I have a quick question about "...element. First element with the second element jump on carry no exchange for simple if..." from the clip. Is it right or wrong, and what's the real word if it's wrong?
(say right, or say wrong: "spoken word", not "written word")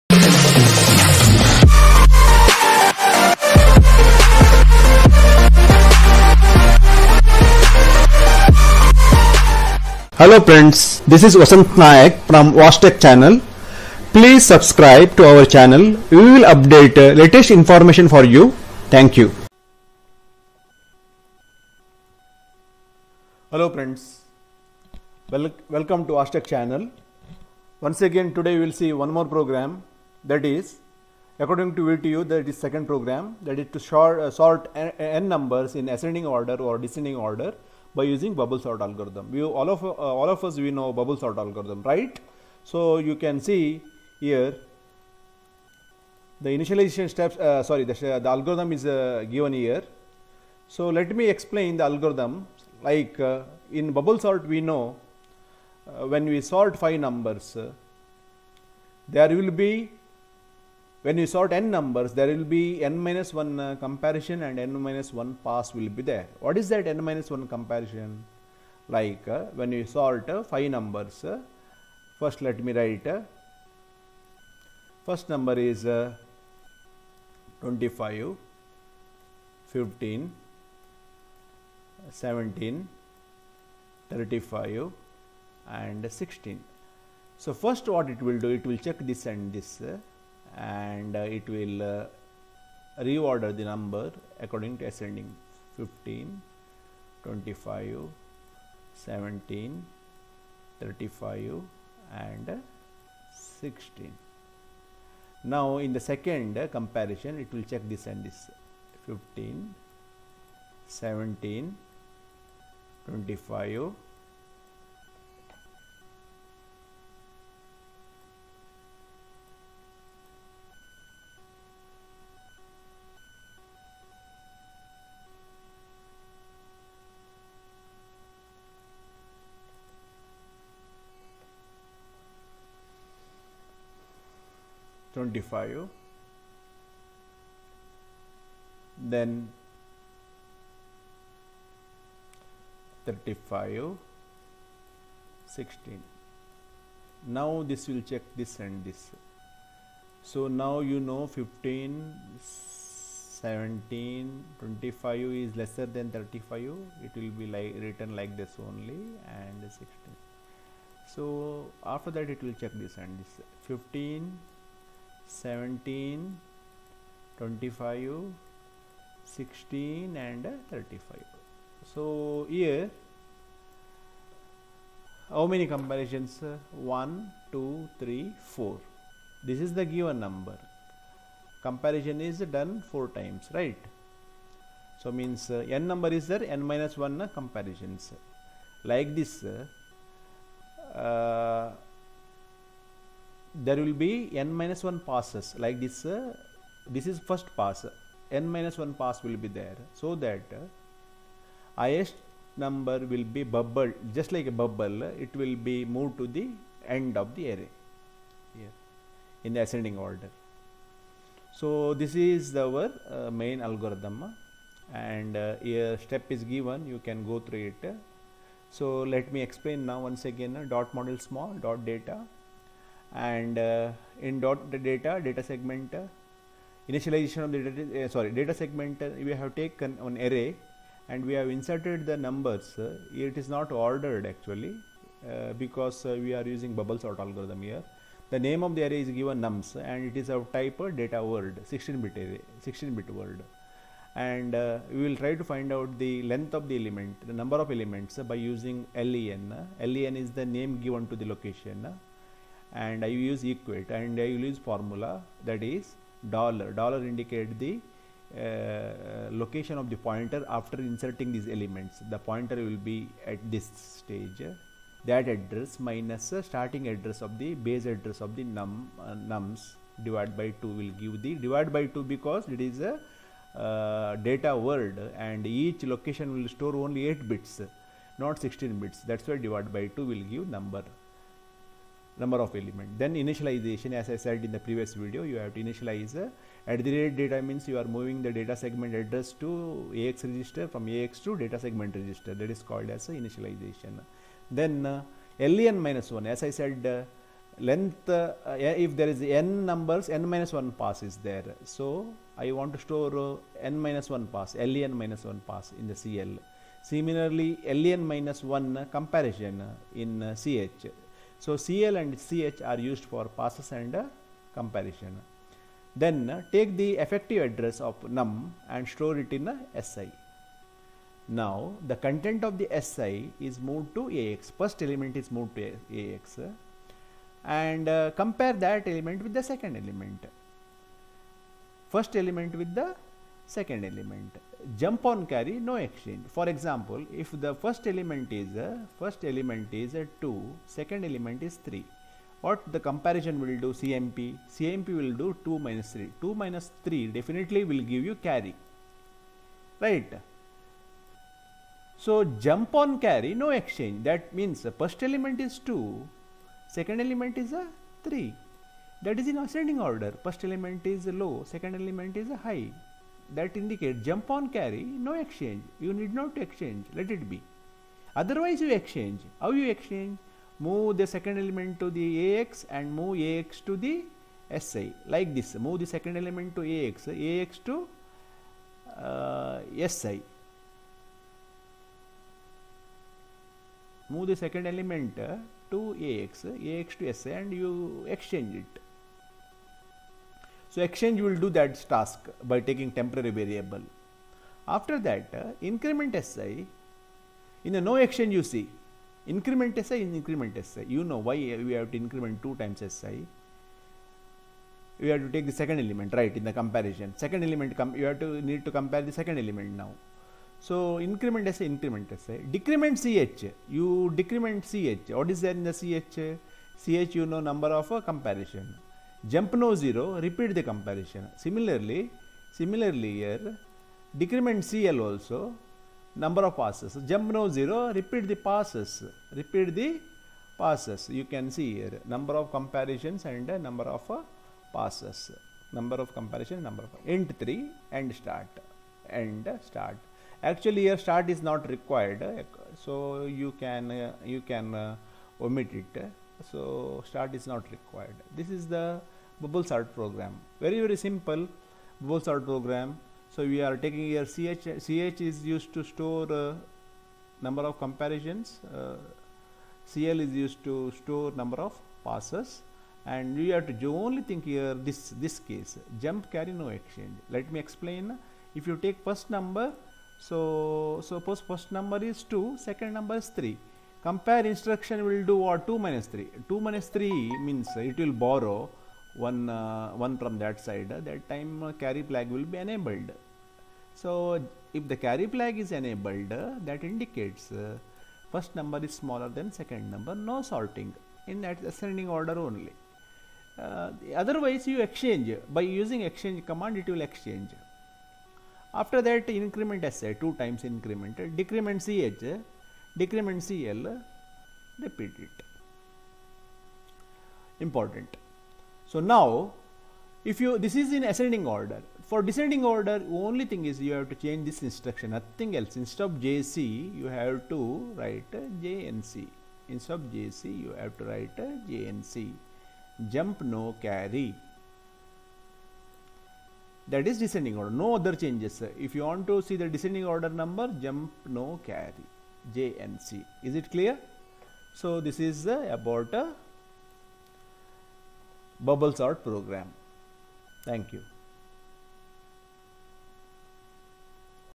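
wrong: "example", not "simple".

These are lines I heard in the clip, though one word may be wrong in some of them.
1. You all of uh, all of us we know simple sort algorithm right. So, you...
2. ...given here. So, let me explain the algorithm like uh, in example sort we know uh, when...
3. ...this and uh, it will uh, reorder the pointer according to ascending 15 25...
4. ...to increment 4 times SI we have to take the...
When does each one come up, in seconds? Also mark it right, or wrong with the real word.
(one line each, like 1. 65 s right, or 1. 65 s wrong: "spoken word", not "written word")
1. 39 s wrong: "bubble", not "simple"
2. 49 s wrong: "bubble", not "example"
3. 89 s wrong: "number", not "pointer"
4. 401 s wrong: "2", not "4".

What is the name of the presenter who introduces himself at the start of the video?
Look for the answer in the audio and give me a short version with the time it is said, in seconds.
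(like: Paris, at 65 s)
Vasanth Nayak, at 11 s.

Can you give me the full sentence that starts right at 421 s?
Similarly, similarly here, decrement CL also, number of passes.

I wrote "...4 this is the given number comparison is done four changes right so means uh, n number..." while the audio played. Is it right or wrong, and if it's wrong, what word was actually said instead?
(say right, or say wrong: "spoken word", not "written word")
wrong: "times", not "changes".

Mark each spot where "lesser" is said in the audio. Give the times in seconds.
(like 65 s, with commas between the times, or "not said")
155 s.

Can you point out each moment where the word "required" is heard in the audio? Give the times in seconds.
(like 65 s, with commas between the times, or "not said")
441 s, 447 s.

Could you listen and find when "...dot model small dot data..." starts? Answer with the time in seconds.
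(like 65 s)
220 s.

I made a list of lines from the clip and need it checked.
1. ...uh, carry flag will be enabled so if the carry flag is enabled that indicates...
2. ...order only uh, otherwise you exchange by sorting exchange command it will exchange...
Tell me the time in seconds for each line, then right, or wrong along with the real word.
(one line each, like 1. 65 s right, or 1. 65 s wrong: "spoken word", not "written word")
1. 481 s right
2. 492 s wrong: "using", not "sorting".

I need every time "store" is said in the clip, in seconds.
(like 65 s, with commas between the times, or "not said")
276 s, 302 s, 318 s, 455 s, 460 s.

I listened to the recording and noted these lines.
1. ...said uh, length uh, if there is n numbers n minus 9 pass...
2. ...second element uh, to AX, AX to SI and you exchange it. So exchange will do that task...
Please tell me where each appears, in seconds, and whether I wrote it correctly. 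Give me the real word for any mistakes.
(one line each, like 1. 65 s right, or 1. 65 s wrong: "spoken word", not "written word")
1. 296 s wrong: "1", not "9"
2. 384 s right.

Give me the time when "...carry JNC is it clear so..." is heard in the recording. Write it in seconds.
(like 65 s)
531 s.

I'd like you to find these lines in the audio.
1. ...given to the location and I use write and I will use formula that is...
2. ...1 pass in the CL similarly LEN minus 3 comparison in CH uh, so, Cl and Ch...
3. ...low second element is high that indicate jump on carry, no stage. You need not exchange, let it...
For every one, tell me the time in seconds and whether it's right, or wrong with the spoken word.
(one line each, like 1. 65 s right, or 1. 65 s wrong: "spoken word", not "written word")
1. 250 s wrong: "equate", not "write"
2. 305 s wrong: "1", not "3"
3. 361 s wrong: "exchange", not "stage".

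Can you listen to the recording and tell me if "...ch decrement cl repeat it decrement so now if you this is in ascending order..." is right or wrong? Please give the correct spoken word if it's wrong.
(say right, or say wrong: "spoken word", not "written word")
wrong: "important", not "decrement".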